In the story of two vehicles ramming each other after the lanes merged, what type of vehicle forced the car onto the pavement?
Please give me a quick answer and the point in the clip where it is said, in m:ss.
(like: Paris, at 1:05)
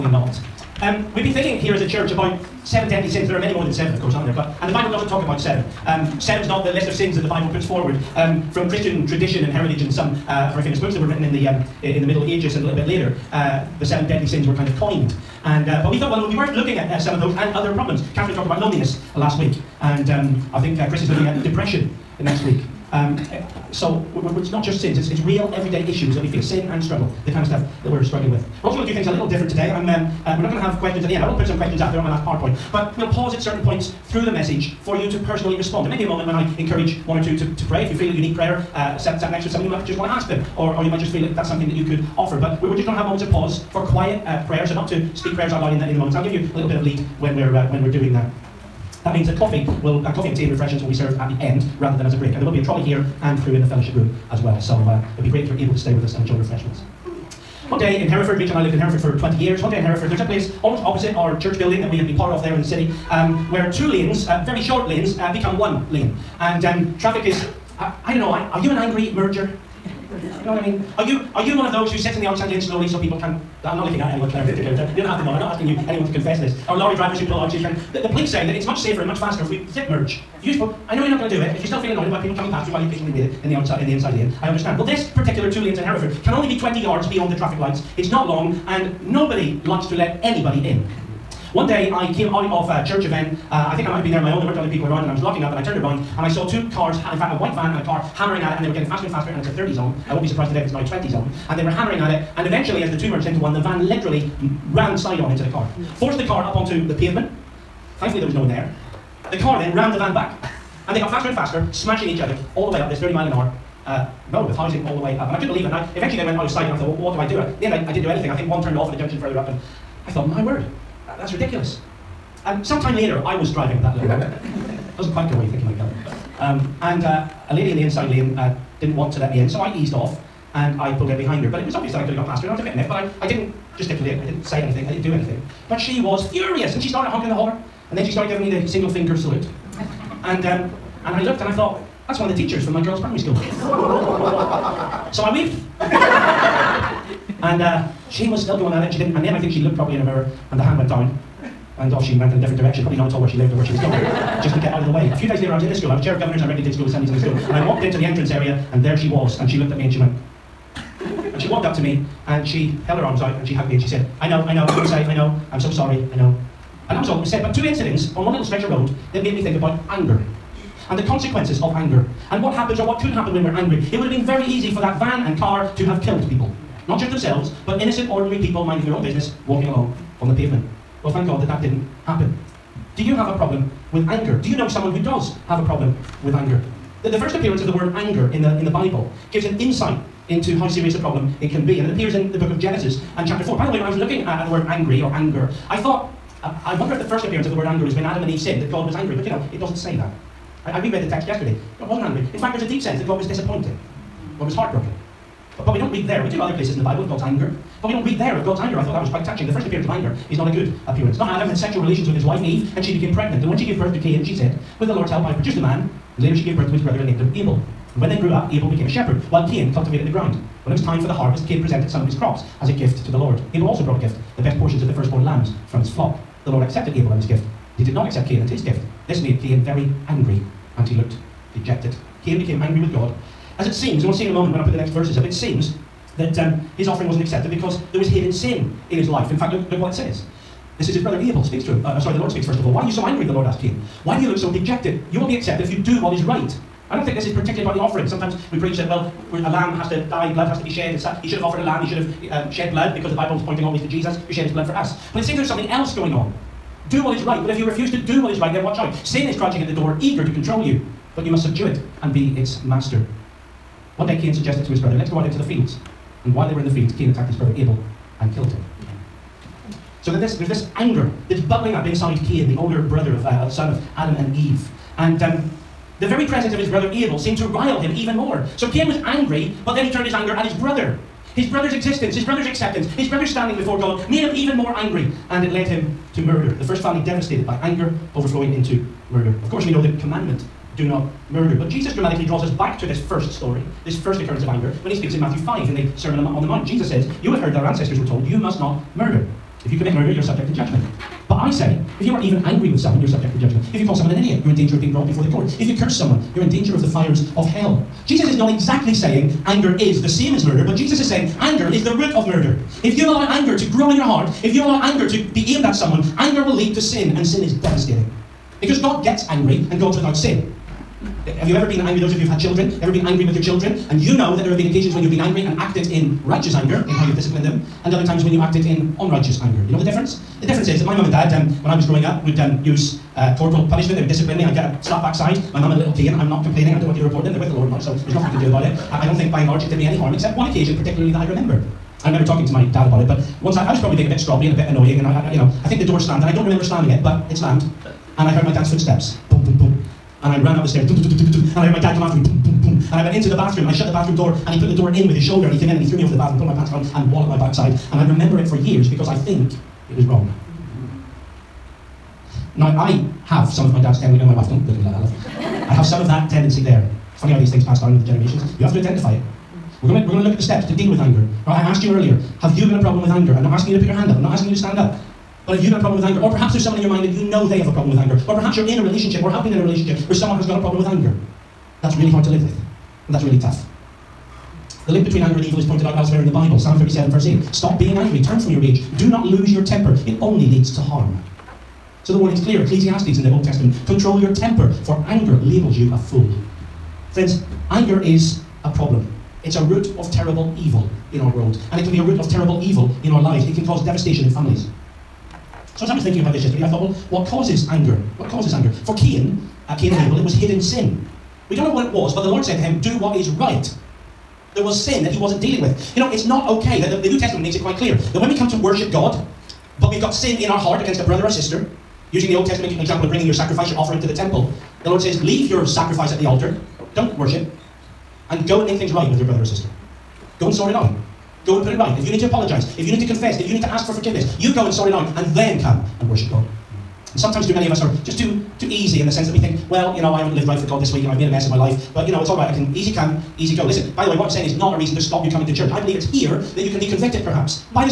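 White van, at 1:37.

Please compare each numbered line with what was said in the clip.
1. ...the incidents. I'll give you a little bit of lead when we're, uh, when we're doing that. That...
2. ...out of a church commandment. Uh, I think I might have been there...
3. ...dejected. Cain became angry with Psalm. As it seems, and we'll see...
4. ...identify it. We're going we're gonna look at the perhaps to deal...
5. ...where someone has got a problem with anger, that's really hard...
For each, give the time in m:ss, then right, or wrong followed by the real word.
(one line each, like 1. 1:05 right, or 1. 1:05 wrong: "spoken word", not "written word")
1. 0:45 wrong: "moments", not "incidents"
2. 1:32 wrong: "event", not "commandment"
3. 3:51 wrong: "God", not "Psalm"
4. 6:08 wrong: "steps", not "perhaps"
5. 6:20 right.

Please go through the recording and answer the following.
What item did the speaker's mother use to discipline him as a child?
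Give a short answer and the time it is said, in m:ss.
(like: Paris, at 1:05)
A little cane, at 5:35.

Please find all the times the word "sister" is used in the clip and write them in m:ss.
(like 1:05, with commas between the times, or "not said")
7:01, 7:09.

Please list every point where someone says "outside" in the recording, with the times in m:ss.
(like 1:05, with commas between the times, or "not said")
1:12, 1:23.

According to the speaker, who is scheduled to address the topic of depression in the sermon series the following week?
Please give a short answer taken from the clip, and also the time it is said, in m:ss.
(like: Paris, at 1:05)
Chris, at 0:20.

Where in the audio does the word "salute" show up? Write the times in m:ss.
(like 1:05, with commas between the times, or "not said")
2:19.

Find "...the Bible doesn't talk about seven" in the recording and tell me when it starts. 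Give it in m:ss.
0:04.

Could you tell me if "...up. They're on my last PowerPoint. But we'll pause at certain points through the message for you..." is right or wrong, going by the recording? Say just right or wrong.
right.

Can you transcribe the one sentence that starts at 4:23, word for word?
One day Cain suggested to his brother, let's go out into the fields.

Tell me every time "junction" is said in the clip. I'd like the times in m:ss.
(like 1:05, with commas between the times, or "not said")
1:58.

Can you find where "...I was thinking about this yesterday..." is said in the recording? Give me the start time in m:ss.
6:45.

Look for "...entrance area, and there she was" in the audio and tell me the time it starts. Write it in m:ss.
2:38.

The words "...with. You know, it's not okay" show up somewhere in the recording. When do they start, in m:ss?
6:55.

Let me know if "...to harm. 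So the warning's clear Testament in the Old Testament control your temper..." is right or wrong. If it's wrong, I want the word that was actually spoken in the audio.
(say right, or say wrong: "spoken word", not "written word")
wrong: "Ecclesiastes", not "Testament".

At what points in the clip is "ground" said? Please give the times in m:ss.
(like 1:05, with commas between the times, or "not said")
3:40.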